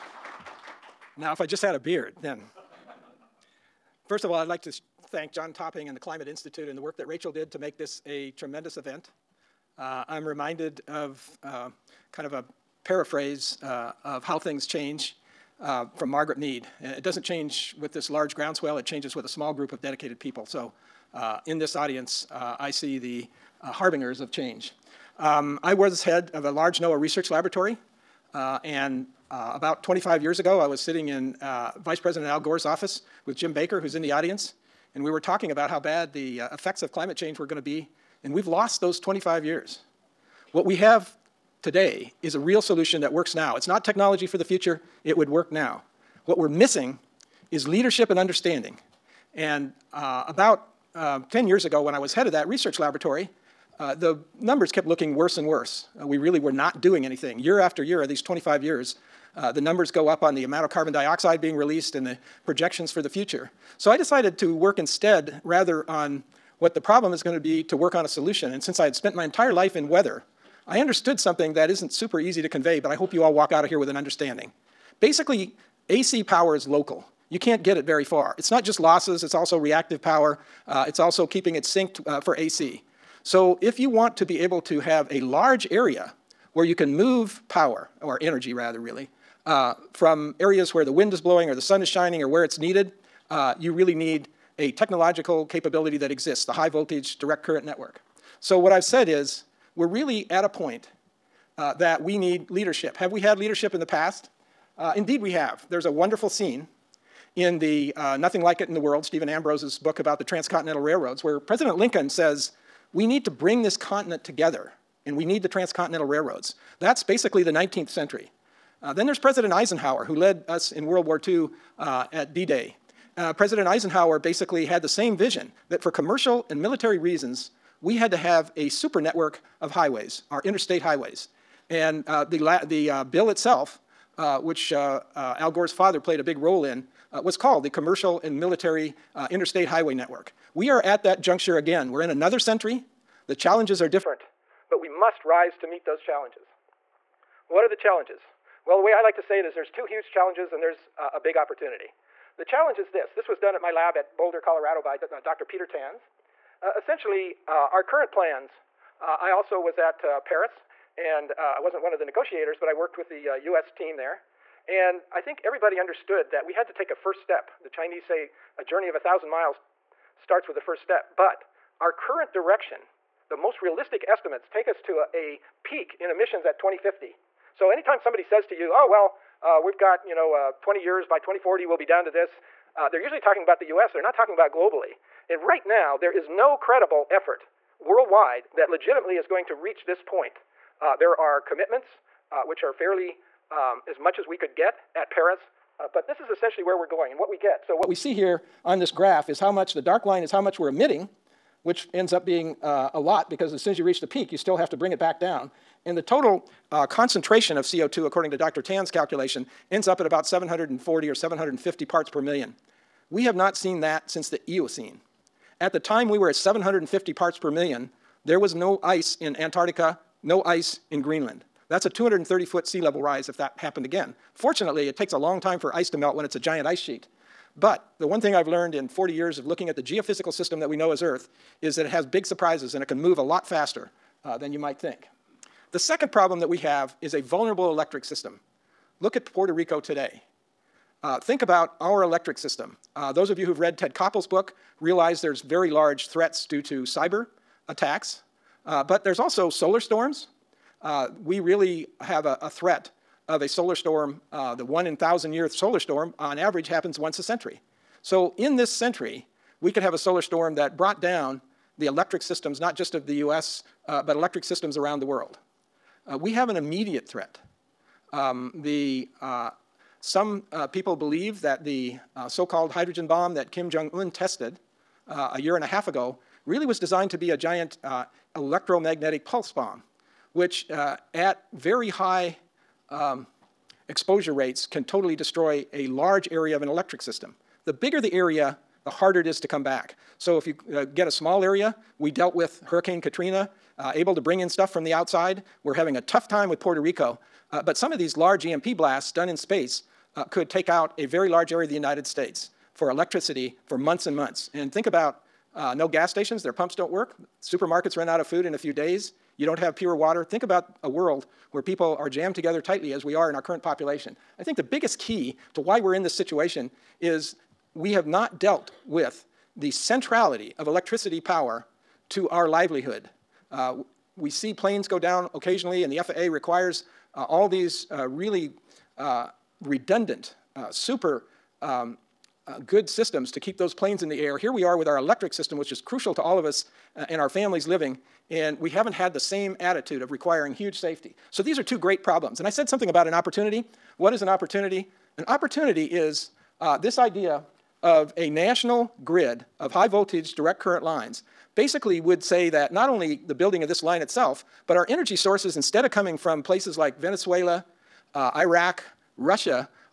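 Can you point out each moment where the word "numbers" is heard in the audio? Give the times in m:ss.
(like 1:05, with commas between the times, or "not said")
0:54, 0:59.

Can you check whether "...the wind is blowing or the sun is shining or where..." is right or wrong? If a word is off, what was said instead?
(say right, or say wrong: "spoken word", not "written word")
right.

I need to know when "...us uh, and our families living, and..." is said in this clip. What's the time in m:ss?
5:36.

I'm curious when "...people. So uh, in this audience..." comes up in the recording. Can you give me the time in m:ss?
0:20.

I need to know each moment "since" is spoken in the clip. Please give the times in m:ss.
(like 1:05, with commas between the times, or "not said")
1:08, 3:34.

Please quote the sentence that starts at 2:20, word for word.
We are at that juncture again.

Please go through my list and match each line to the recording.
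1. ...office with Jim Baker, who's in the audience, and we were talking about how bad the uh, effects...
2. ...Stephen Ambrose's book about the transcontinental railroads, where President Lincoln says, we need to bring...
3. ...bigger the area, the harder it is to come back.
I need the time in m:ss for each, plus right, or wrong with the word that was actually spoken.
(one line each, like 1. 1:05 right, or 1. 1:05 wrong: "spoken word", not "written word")
1. 0:32 right
2. 1:49 right
3. 4:47 right.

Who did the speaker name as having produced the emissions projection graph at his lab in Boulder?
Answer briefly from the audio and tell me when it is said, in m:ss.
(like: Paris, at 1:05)
Dr. Peter Tans, at 2:35.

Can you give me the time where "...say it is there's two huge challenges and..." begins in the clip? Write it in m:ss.
2:29.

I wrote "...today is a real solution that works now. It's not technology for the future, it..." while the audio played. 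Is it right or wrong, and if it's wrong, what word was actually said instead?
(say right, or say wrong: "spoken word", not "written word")
right.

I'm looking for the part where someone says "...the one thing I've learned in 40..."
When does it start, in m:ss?
3:47.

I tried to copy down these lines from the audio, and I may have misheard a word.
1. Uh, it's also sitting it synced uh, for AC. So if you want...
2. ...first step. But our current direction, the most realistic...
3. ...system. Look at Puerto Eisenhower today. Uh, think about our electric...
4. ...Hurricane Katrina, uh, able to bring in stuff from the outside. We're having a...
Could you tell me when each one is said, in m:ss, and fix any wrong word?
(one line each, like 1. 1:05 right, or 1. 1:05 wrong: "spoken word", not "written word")
1. 1:20 wrong: "keeping", not "sitting"
2. 2:50 right
3. 3:58 wrong: "Rico", not "Eisenhower"
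4. 4:52 right.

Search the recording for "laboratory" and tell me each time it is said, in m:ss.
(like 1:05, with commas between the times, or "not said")
0:27, 0:52.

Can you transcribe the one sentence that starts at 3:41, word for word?
That's a 230 foot sea level rise if that happened again.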